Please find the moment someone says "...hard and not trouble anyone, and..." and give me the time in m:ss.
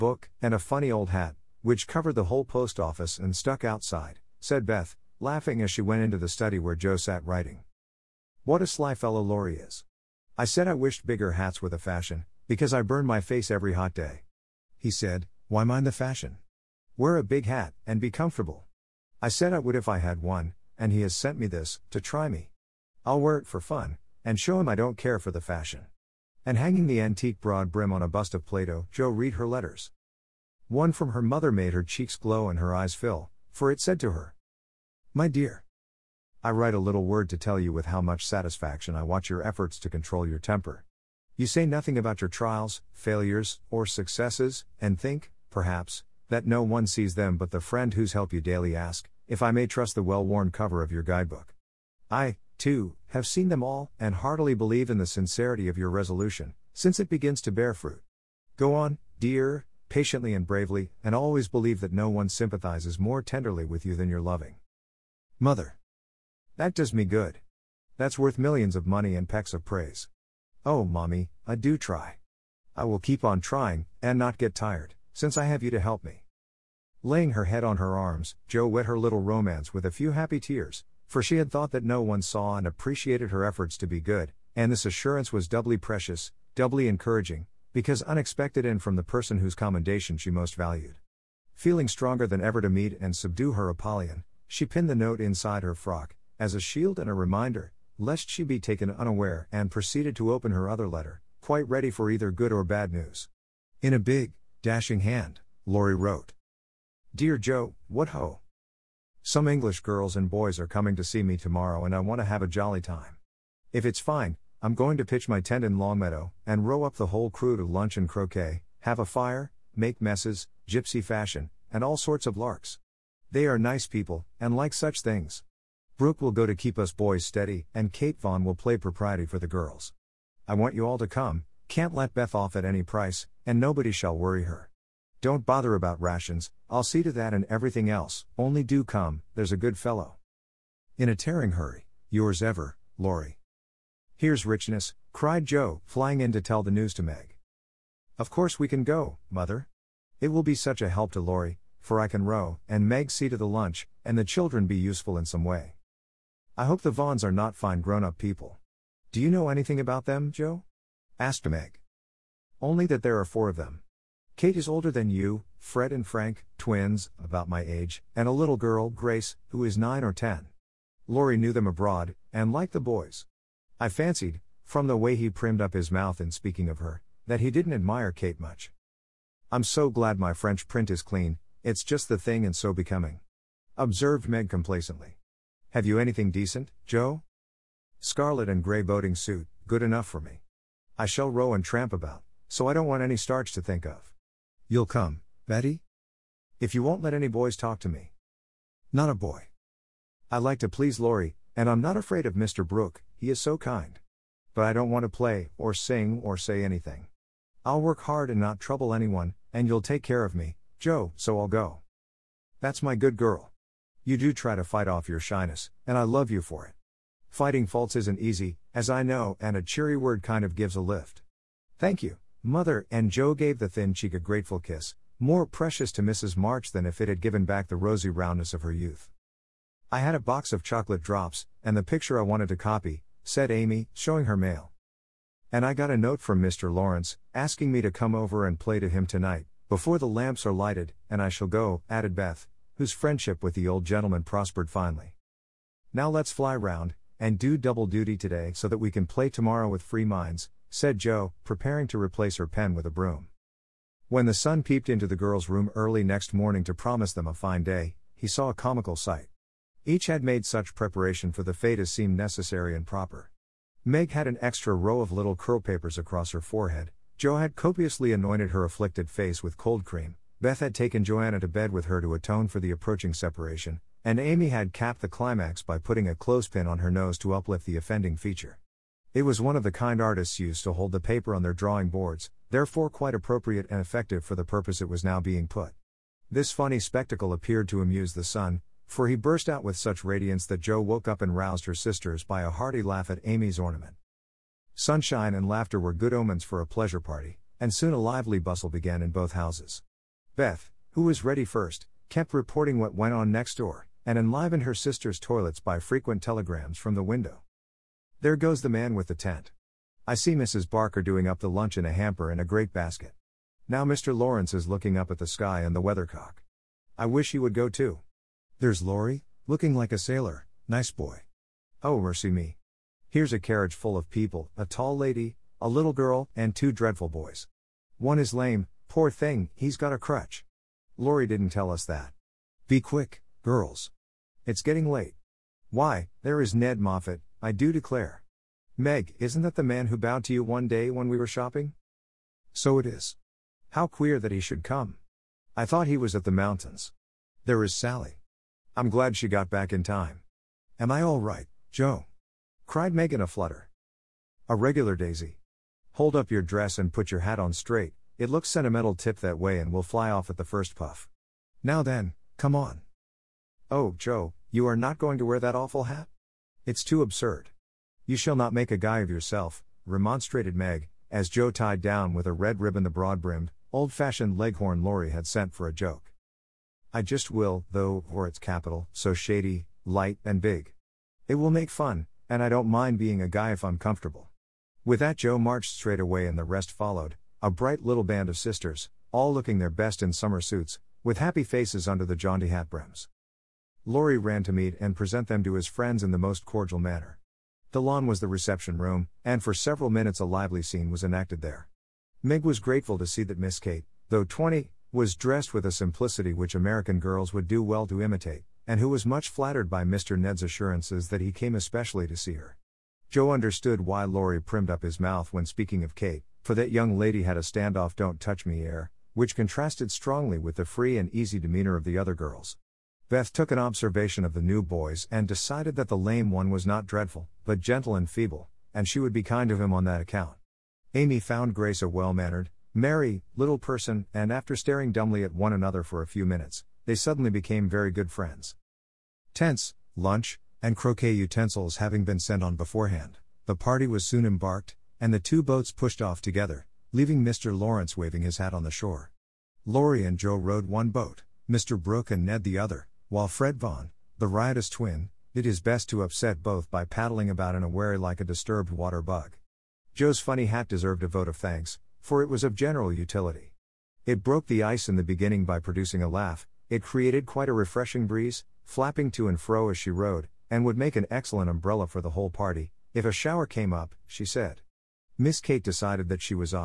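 3:28.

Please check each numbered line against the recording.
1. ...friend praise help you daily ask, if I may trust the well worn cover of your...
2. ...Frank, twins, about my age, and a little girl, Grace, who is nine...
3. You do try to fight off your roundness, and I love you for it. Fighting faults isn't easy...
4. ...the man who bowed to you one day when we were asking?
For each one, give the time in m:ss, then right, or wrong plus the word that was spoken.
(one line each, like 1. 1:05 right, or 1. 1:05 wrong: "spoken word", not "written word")
1. 0:47 wrong: "whose", not "praise"
2. 2:46 right
3. 3:34 wrong: "shyness", not "roundness"
4. 5:39 wrong: "shopping", not "asking".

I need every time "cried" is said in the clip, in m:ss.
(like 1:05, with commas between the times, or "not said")
2:25, 5:52.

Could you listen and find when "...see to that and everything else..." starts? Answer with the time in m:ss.
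2:16.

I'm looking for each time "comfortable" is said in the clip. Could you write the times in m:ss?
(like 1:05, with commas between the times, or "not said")
0:18, 6:23.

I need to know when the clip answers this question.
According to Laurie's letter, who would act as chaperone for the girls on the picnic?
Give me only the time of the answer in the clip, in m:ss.
2:07.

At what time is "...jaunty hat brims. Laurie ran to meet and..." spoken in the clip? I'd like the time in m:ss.
6:32.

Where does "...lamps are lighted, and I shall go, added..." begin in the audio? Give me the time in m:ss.
4:00.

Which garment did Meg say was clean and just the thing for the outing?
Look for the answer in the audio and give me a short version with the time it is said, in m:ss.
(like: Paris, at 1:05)
French print, at 3:00.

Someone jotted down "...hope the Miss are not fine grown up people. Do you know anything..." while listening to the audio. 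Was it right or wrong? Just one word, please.
wrong.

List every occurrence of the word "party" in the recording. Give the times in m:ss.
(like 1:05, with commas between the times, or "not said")
4:56, 7:23, 7:52.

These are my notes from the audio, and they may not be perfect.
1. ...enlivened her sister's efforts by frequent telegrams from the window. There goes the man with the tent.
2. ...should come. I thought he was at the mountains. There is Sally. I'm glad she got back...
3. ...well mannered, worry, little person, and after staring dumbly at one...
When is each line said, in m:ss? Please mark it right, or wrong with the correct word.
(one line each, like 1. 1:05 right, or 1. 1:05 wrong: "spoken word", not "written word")
1. 5:04 wrong: "toilets", not "efforts"
2. 5:44 right
3. 7:11 wrong: "merry", not "worry".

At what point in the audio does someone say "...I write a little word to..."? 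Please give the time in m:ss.
0:36.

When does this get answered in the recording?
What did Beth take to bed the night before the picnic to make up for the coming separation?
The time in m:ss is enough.
4:31.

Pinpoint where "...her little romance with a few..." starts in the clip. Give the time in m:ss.
1:18.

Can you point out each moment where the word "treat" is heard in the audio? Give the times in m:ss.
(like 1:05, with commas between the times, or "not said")
not said.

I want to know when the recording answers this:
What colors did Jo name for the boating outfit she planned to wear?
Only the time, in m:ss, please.
3:07.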